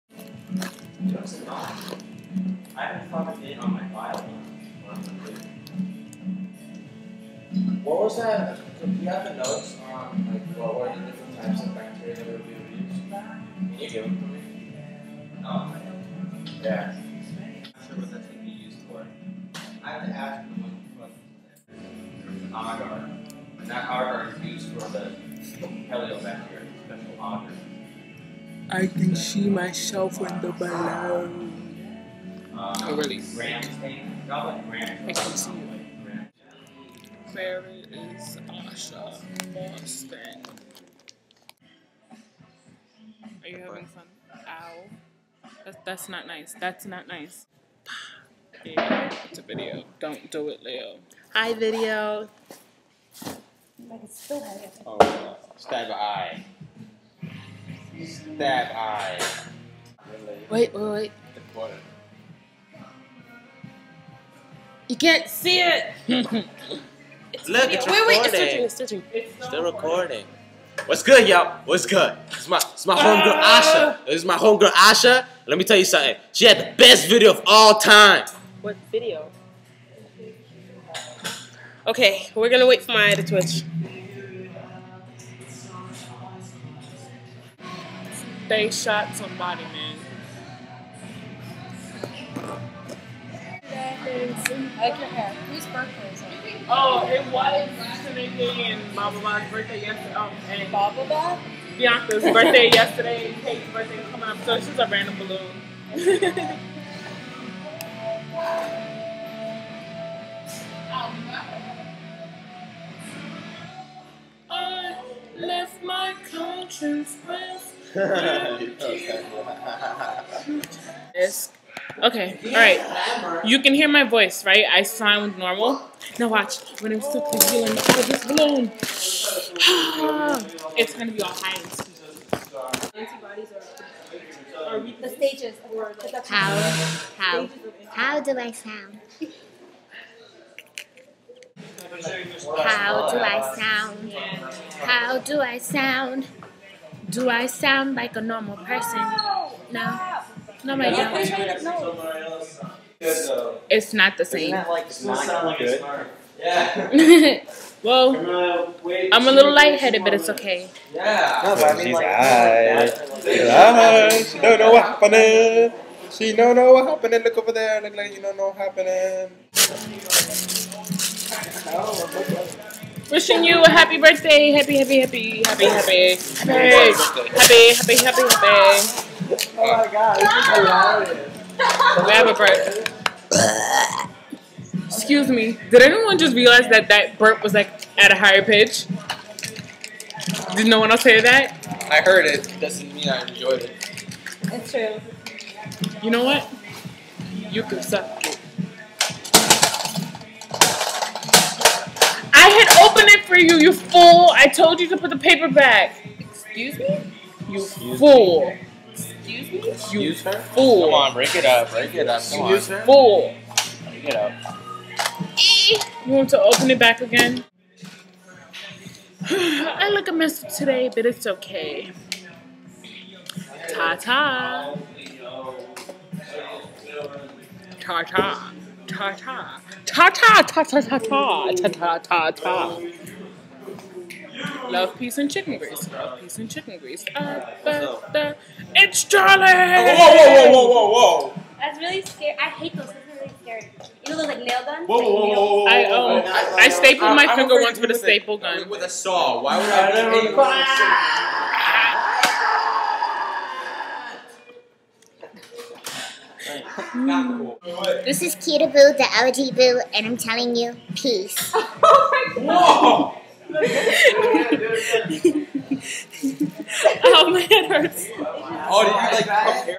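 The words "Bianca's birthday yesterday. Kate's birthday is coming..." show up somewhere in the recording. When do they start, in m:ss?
1:41.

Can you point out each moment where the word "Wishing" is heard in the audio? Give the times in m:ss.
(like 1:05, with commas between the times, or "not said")
2:53.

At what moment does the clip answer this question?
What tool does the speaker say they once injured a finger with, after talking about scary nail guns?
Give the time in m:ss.
4:07.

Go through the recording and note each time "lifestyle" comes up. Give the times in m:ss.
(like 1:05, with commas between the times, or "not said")
not said.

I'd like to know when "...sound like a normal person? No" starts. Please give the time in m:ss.
2:27.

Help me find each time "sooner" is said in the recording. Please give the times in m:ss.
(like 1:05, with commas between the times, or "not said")
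not said.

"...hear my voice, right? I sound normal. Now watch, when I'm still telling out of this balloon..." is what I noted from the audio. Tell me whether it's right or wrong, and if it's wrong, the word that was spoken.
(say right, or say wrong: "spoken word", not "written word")
wrong: "feeling", not "telling".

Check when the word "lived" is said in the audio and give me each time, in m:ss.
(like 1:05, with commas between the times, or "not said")
not said.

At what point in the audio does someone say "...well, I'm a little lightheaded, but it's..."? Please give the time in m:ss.
2:37.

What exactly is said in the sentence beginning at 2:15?
the stages of how how how do I sound?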